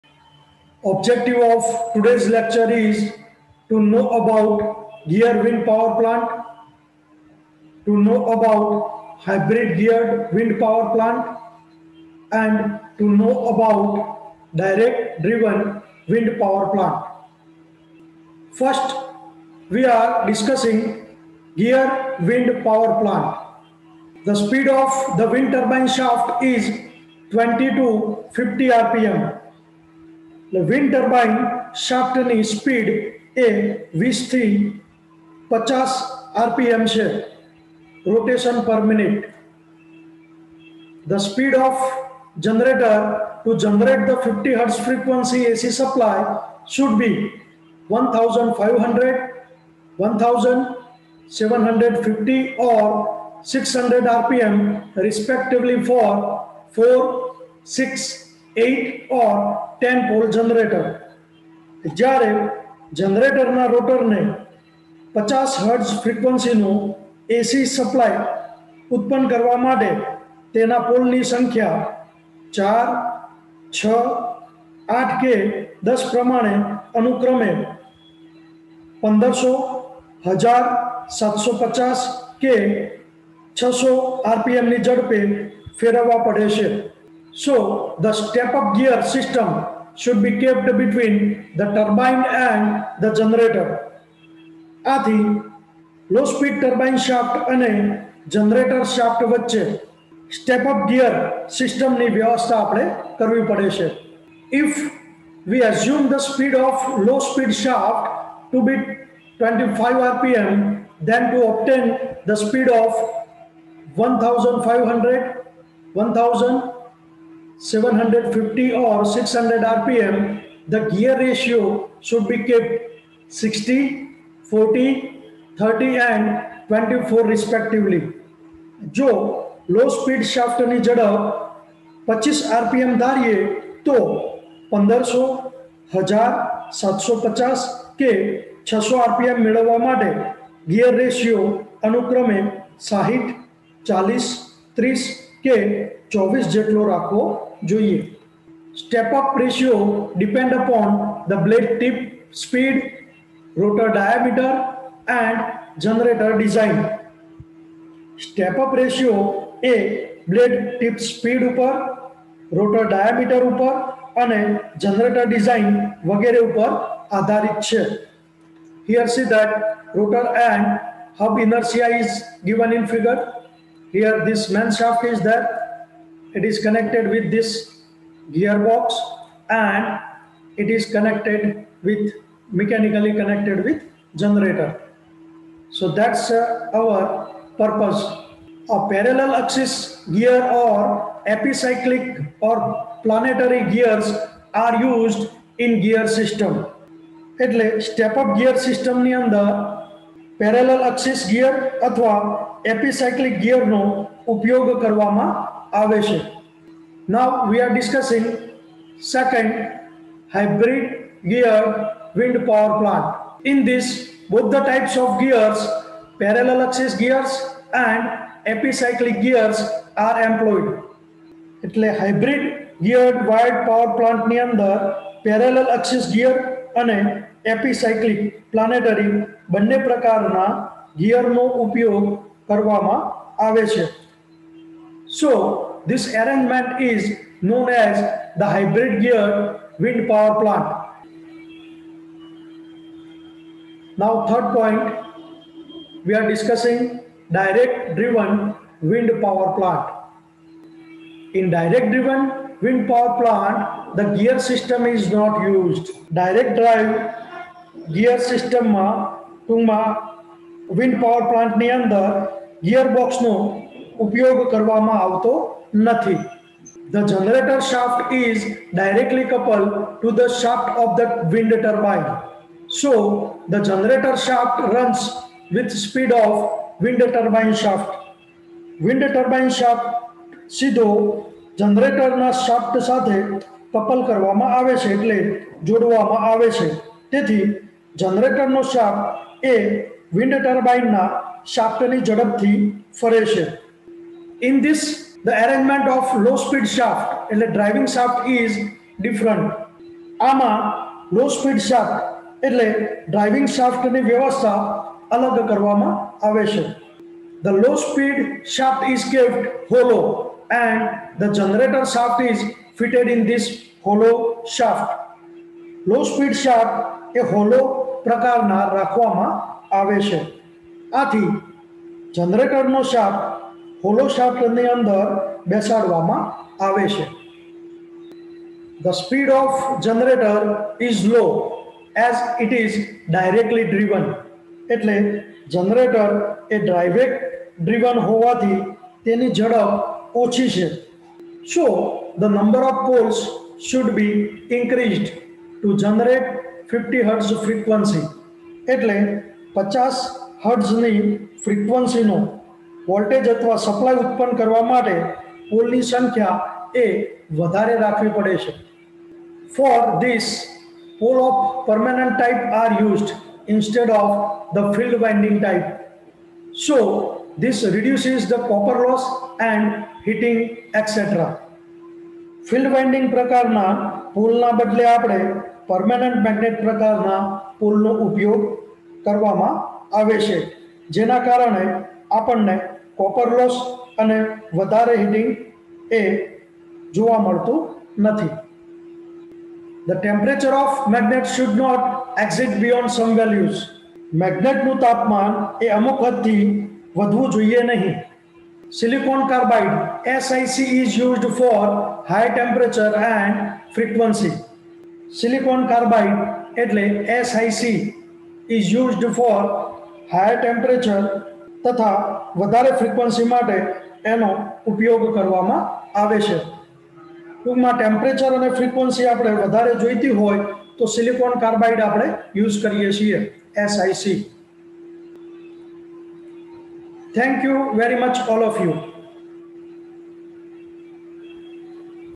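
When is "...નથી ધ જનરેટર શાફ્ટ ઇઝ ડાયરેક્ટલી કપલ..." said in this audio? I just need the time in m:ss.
4:25.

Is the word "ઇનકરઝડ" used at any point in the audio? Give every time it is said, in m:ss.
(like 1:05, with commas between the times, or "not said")
5:44.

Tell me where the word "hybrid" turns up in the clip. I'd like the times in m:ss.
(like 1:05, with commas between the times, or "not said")
0:09, 3:30, 3:58.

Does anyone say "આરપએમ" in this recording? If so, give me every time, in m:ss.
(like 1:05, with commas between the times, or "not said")
0:36, 0:54.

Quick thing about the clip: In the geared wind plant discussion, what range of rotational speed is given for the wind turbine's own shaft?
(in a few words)
20 to 50 rpm.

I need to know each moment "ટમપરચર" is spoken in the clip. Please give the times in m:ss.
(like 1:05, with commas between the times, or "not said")
6:30, 6:57.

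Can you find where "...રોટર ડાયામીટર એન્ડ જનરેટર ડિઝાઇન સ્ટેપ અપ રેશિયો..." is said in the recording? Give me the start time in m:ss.
2:33.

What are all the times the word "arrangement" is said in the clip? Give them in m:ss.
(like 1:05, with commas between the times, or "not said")
3:56, 4:55.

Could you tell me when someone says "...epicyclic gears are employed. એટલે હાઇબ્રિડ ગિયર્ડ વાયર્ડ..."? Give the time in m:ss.
3:38.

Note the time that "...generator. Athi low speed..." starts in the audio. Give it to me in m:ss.
1:33.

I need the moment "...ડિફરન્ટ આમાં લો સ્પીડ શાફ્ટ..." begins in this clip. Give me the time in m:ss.
4:59.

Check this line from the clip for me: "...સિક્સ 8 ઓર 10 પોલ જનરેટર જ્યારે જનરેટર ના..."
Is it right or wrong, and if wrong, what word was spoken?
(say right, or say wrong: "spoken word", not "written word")
right.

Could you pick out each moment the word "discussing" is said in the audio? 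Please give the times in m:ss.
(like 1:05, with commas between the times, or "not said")
0:20, 3:27, 4:06.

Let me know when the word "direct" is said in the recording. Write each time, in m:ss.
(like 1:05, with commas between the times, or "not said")
0:14, 4:07, 4:11, 4:16.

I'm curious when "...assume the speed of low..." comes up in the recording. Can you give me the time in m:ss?
1:45.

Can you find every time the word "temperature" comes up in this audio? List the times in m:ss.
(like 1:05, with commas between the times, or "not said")
6:42, 6:50.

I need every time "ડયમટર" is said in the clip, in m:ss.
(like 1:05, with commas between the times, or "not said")
2:33, 2:42.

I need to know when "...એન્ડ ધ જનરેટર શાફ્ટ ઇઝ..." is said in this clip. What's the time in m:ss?
5:10.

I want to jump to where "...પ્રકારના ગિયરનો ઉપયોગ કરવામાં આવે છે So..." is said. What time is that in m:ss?
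3:49.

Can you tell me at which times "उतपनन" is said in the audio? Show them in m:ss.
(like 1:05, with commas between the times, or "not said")
5:54.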